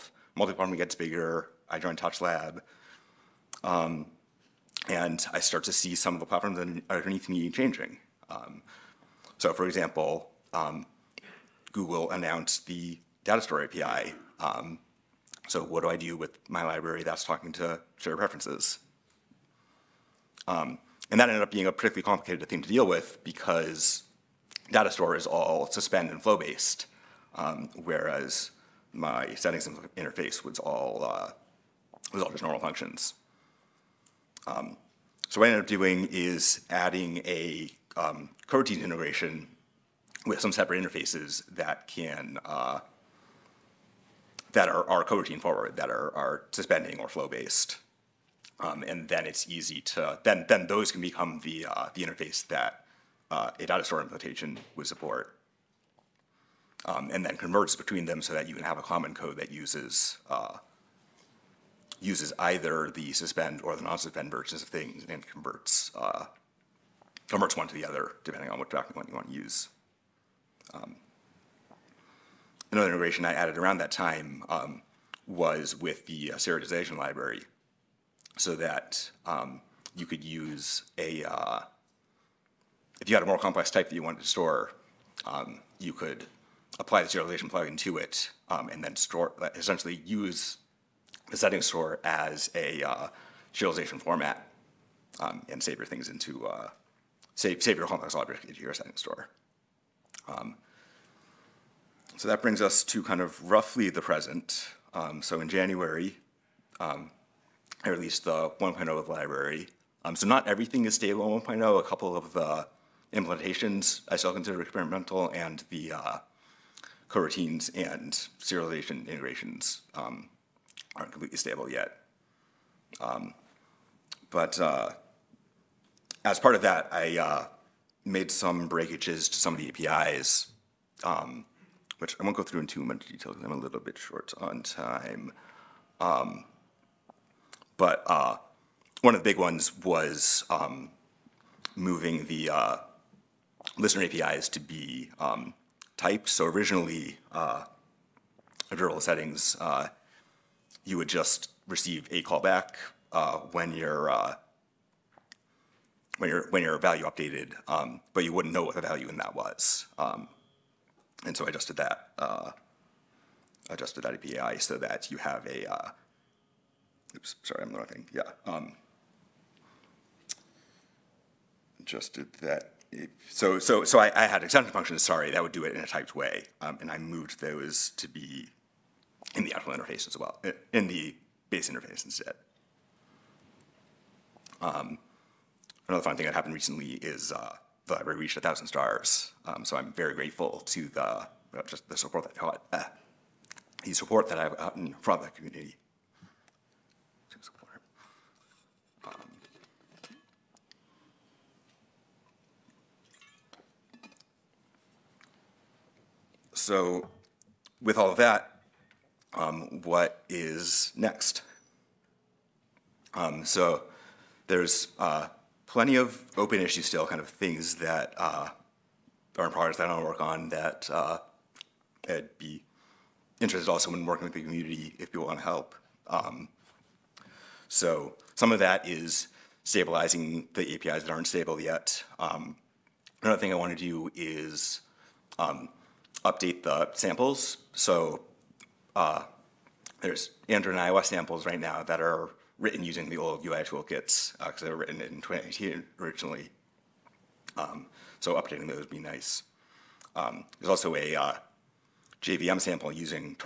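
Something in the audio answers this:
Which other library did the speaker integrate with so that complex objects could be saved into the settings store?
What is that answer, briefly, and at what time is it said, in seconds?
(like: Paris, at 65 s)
serialization library, at 76 s.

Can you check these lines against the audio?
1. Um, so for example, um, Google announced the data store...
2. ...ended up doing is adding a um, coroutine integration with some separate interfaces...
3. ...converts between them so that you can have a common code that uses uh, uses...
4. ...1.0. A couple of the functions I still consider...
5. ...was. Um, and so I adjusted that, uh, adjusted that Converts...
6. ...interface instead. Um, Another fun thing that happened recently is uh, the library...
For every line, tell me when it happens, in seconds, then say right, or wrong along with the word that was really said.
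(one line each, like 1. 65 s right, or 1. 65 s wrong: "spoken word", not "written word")
1. 8 s right
2. 35 s right
3. 57 s right
4. 111 s wrong: "implementations", not "functions"
5. 159 s wrong: "API", not "Converts"
6. 181 s right.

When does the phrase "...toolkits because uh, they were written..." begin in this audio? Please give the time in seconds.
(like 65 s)
243 s.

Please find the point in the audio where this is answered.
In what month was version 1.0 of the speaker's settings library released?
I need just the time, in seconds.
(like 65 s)
105 s.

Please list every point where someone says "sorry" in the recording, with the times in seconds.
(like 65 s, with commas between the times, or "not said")
167 s, 175 s.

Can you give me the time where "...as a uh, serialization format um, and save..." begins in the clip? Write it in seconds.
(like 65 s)
92 s.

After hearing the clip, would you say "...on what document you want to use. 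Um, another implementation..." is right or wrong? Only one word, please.
wrong.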